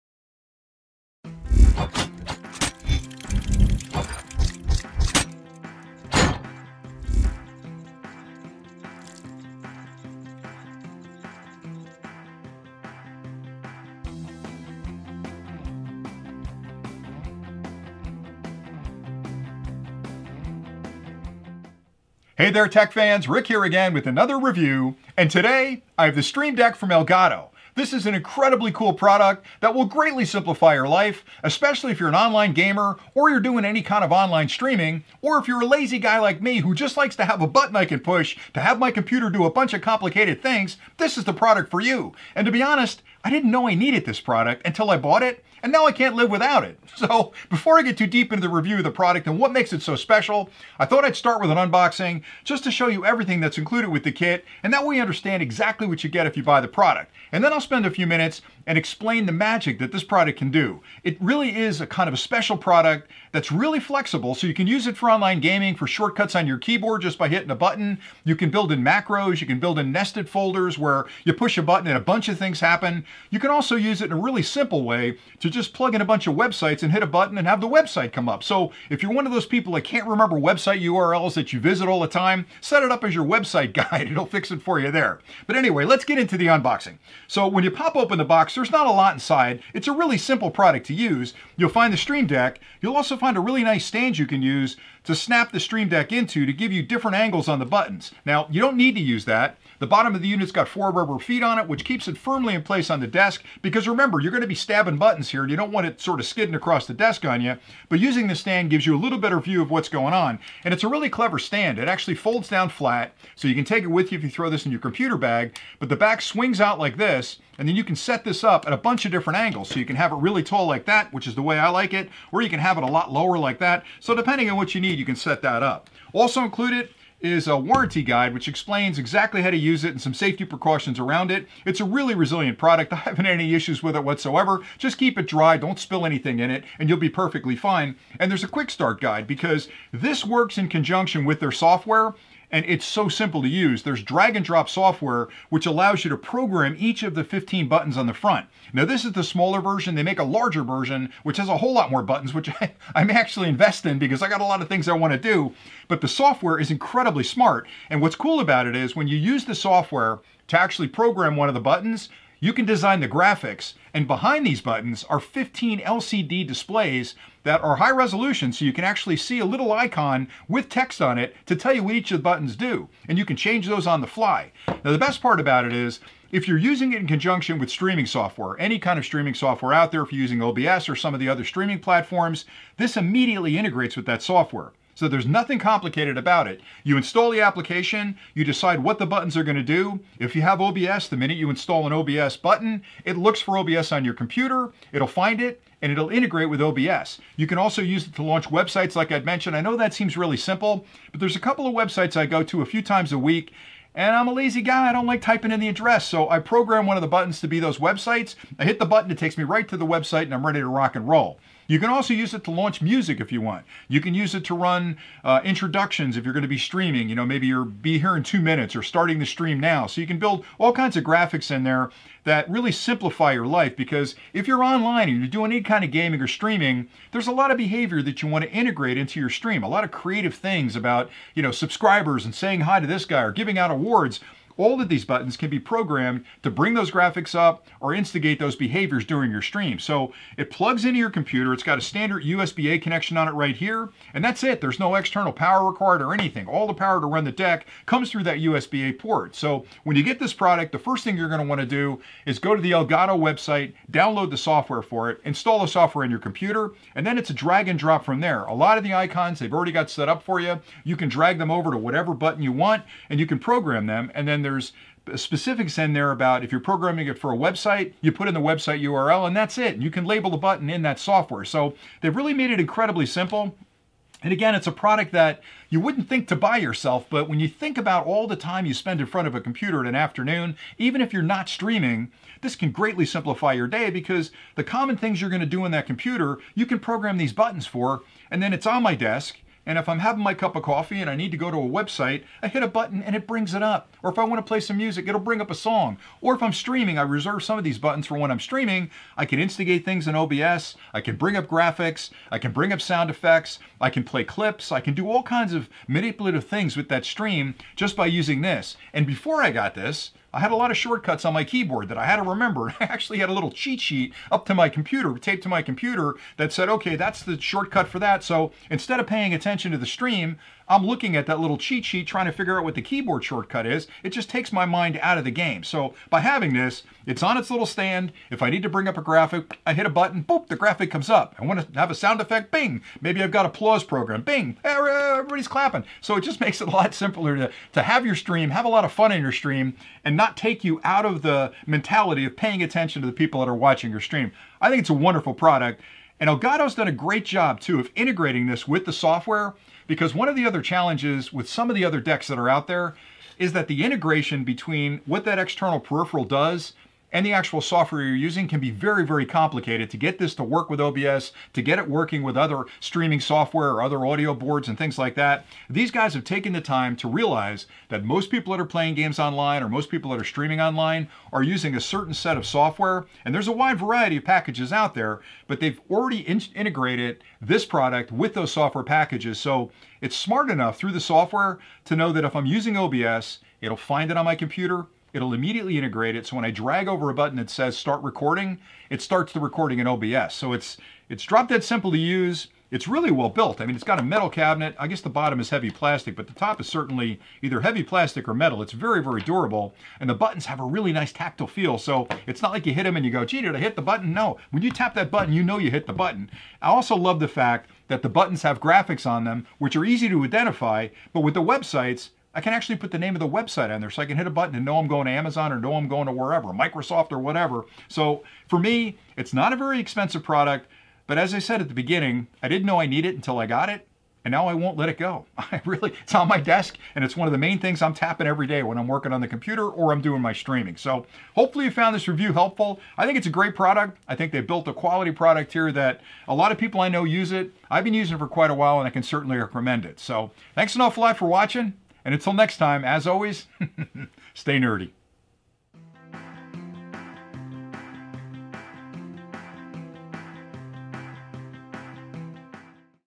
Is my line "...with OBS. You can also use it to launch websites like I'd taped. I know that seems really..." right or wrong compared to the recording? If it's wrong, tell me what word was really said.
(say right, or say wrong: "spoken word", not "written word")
wrong: "mentioned", not "taped".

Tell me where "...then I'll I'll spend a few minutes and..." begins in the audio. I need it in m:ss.
0:57.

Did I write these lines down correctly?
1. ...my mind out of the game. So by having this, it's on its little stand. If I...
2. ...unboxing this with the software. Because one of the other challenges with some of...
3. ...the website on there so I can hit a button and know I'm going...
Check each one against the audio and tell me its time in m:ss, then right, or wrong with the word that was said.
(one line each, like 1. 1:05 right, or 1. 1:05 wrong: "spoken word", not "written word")
1. 5:24 right
2. 5:47 wrong: "integrating", not "unboxing"
3. 6:53 right.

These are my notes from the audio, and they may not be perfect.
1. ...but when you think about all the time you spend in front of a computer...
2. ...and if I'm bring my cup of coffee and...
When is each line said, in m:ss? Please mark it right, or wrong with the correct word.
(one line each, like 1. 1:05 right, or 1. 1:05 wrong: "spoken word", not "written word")
1. 4:37 right
2. 4:49 wrong: "having", not "bring".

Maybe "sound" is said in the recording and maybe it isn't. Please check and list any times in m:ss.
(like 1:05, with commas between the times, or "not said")
5:02, 5:31.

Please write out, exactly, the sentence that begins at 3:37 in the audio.
You know, maybe you're be here in two minutes or starting the stream now.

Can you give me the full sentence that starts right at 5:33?
Maybe I've got applause program, bing, eh, er, everybody's clapping.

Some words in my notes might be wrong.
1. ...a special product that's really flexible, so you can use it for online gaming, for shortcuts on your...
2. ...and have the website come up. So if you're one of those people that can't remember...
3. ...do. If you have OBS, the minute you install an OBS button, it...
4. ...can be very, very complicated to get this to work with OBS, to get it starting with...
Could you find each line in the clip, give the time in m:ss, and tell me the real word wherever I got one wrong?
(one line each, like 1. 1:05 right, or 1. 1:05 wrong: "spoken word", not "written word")
1. 1:02 right
2. 1:17 right
3. 3:09 right
4. 5:58 wrong: "working", not "starting".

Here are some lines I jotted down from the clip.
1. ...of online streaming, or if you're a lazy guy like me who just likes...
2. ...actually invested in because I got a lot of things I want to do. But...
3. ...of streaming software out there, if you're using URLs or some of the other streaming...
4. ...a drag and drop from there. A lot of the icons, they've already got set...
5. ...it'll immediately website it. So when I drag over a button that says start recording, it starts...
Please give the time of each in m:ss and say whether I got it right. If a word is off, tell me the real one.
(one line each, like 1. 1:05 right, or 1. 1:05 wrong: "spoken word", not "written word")
1. 0:34 right
2. 2:33 right
3. 2:58 wrong: "OBS", not "URLs"
4. 4:17 right
5. 6:25 wrong: "integrate", not "website".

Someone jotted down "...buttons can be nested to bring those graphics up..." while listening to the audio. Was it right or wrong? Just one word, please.
wrong.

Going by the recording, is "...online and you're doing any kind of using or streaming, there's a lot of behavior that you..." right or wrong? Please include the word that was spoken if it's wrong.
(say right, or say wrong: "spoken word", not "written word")
wrong: "gaming", not "using".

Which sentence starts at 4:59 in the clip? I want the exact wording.
I can instigate things in OBS.